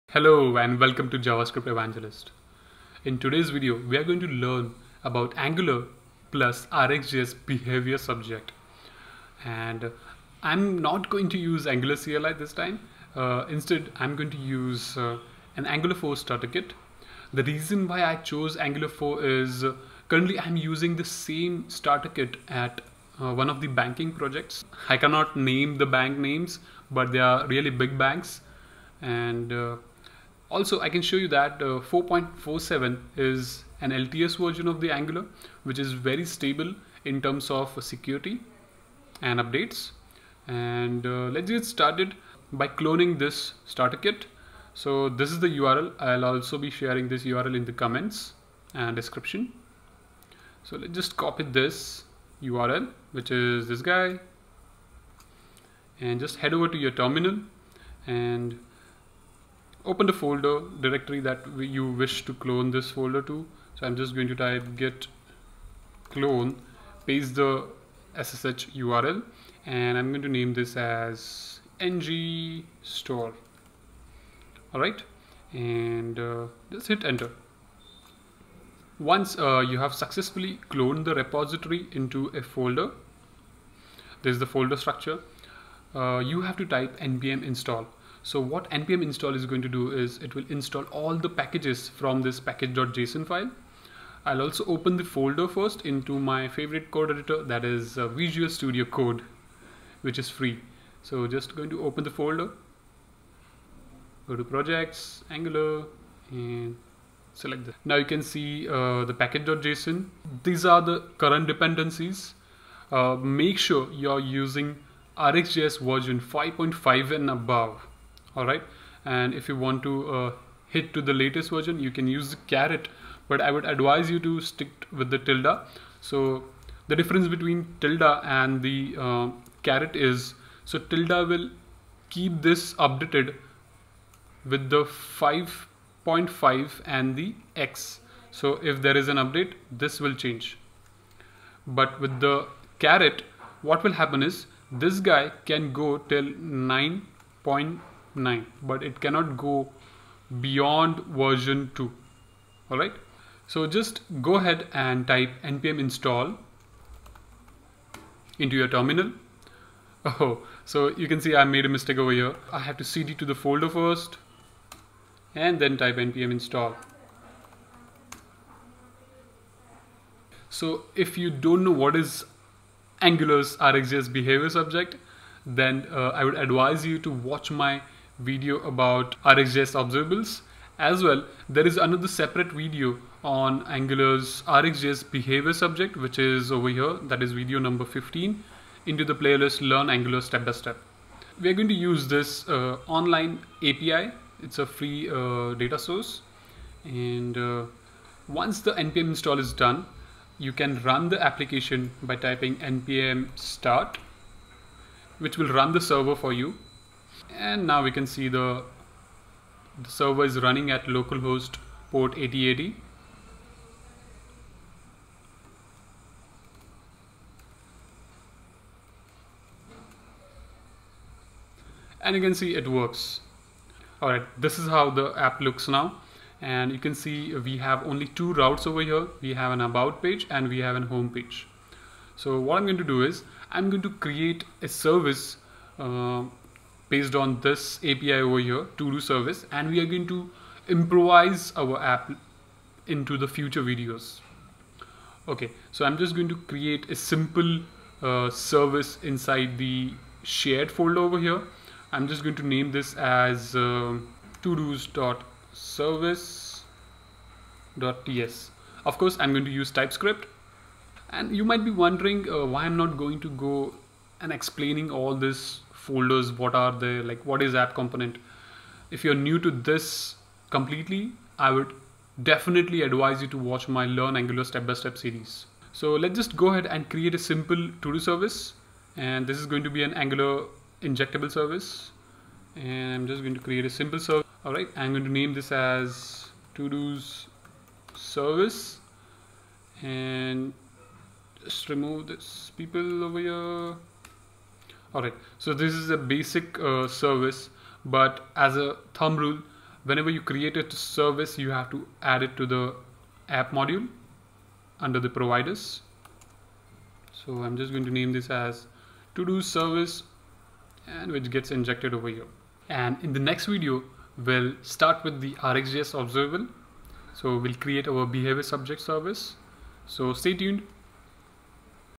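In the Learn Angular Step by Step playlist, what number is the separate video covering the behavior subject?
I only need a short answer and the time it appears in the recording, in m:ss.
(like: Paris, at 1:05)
15, at 3:07.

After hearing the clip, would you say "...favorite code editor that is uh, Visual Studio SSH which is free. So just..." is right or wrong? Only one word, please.
wrong.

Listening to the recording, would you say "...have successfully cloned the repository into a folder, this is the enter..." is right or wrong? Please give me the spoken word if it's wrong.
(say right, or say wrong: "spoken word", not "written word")
wrong: "folder", not "enter".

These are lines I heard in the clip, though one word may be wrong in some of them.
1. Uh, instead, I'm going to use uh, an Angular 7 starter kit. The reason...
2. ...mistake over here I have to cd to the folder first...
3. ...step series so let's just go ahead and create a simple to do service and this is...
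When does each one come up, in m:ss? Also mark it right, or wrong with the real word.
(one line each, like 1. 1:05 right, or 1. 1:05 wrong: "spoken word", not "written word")
1. 0:13 wrong: "4", not "7"
2. 2:41 right
3. 4:34 right.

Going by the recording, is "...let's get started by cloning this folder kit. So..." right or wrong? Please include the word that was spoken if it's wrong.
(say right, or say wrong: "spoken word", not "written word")
wrong: "starter", not "folder".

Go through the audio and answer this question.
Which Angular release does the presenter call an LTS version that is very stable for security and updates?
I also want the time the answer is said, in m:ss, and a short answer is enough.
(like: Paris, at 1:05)
4.47, at 0:31.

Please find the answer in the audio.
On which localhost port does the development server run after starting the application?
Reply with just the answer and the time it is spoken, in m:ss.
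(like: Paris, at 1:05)
8080, at 3:32.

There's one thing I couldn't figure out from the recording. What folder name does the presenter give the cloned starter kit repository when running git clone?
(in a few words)
ng store.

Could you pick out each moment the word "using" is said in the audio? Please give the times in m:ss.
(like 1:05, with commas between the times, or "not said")
0:20, 1:54.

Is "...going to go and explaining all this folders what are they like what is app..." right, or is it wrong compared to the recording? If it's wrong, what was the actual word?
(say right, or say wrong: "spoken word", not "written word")
right.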